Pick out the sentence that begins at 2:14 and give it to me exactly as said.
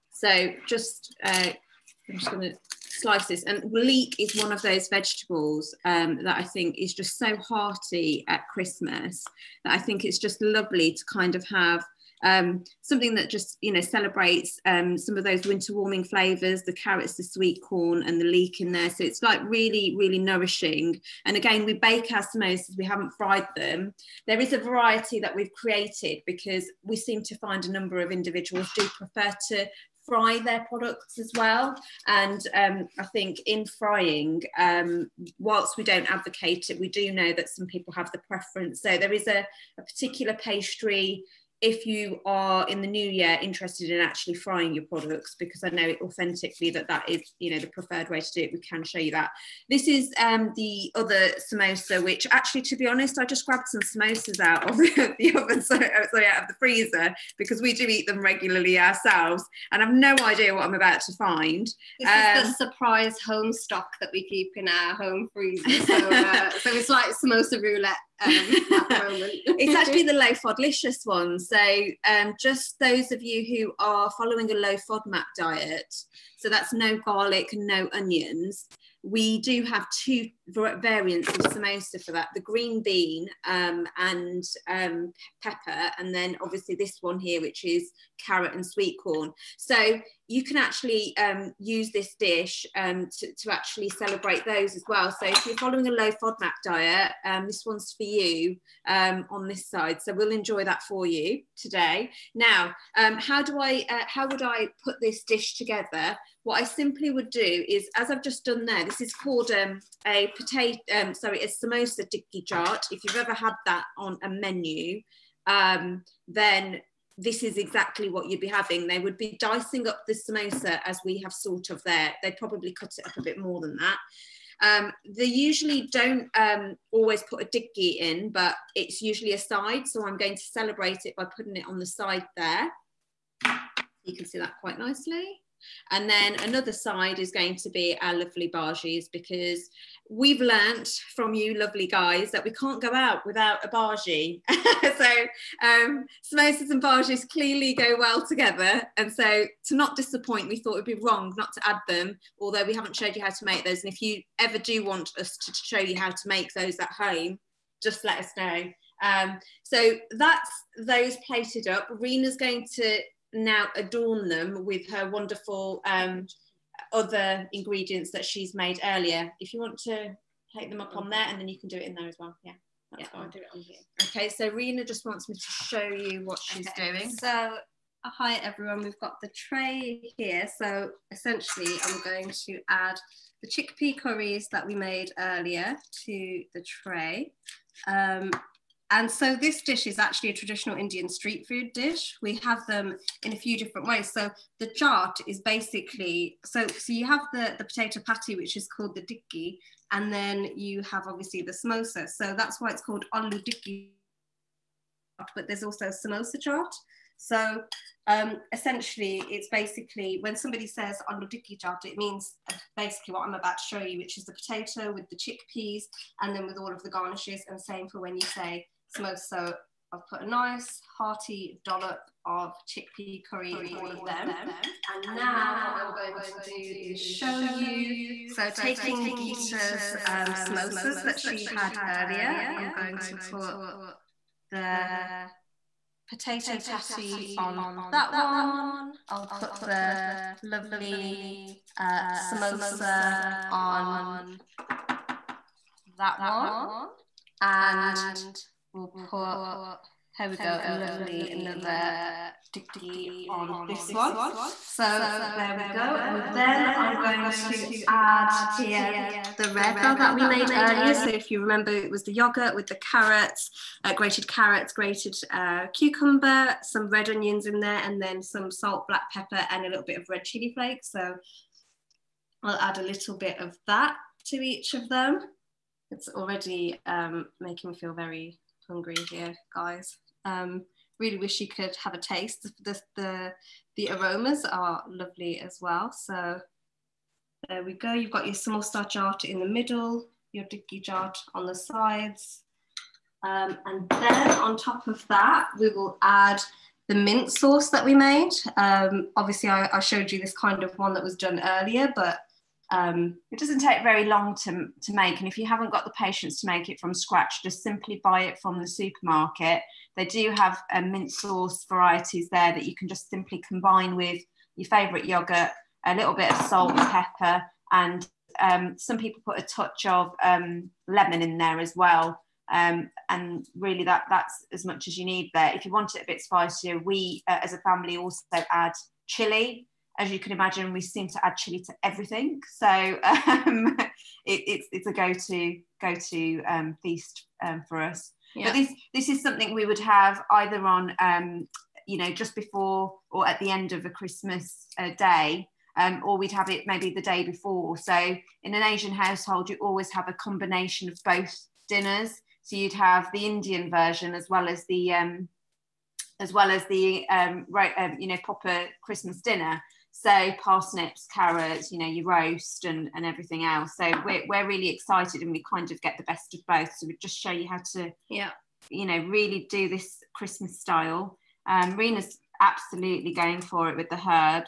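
You can see that quite nicely.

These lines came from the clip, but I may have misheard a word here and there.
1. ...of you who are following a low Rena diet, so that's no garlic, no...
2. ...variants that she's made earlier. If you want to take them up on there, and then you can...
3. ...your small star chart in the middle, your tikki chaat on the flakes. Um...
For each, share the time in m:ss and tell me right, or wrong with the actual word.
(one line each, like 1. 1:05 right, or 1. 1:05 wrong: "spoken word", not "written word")
1. 1:13 wrong: "FODMAP", not "Rena"
2. 2:47 wrong: "ingredients", not "variants"
3. 4:48 wrong: "sides", not "flakes".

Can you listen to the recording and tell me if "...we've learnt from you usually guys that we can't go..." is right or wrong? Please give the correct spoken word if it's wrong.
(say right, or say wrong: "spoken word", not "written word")
wrong: "lovely", not "usually".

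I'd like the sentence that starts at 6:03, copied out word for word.
So we're, we're really excited and we kind of get the best of both.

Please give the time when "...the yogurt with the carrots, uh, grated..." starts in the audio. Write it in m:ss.
4:22.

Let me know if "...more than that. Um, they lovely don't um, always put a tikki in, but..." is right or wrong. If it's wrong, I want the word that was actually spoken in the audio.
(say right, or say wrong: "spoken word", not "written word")
wrong: "usually", not "lovely".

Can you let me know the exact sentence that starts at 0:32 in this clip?
And um, I think in frying, um, whilst we don't advocate it, we do know that some people have the preference.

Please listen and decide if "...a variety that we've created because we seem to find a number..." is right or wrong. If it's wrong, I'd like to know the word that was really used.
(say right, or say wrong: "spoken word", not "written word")
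right.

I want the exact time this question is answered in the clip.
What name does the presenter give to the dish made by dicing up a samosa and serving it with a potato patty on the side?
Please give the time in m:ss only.
1:51.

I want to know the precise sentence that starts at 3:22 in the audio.
So that's why it's called aloo dikki, but there's also samosa chaat.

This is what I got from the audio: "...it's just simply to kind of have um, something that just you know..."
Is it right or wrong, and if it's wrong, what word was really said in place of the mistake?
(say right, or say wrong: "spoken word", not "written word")
wrong: "lovely", not "simply".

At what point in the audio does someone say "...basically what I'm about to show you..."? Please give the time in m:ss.
3:32.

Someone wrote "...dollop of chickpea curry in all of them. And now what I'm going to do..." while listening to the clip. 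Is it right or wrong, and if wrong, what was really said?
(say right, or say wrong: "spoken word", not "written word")
right.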